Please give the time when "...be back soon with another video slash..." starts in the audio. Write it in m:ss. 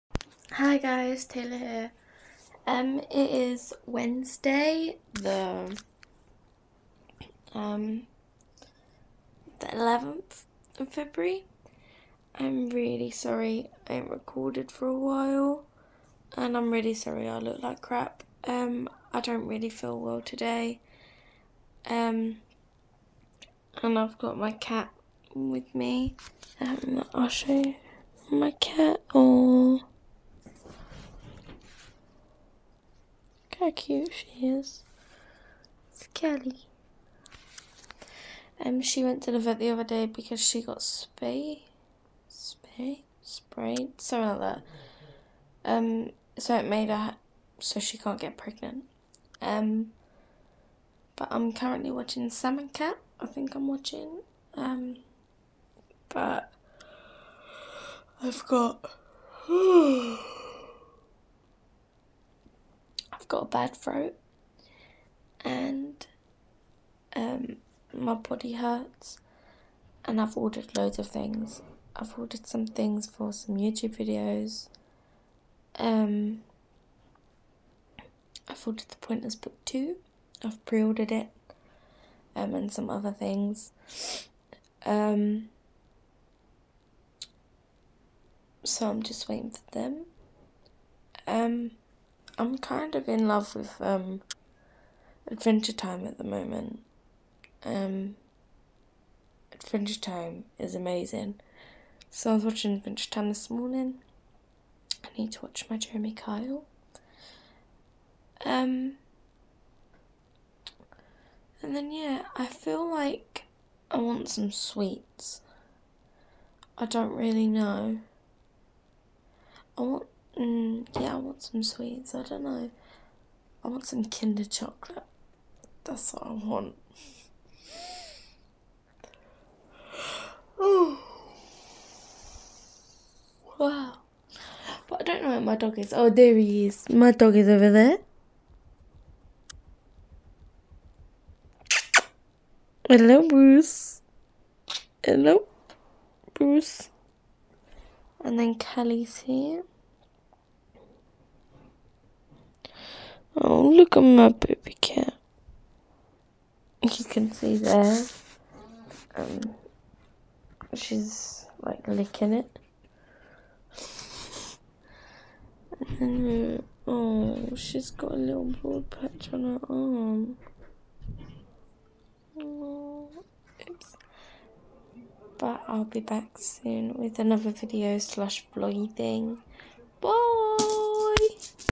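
2:55.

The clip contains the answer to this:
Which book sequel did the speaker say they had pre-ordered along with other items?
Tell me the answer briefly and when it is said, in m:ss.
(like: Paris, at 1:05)
The Pointless Book 2, at 1:18.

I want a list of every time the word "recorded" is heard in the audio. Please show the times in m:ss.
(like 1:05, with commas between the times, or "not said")
0:14.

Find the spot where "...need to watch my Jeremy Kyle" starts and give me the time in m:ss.
1:45.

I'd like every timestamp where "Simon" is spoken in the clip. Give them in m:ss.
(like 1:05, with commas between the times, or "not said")
0:52.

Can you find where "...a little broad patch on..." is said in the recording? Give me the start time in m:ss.
2:48.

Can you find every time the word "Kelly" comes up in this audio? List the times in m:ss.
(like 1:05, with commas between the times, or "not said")
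0:36, 2:28.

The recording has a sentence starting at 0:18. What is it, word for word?
Um, I don't really feel well today.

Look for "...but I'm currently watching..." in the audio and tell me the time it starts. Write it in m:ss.
0:51.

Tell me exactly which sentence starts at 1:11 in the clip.
I've ordered some things for some YouTube videos.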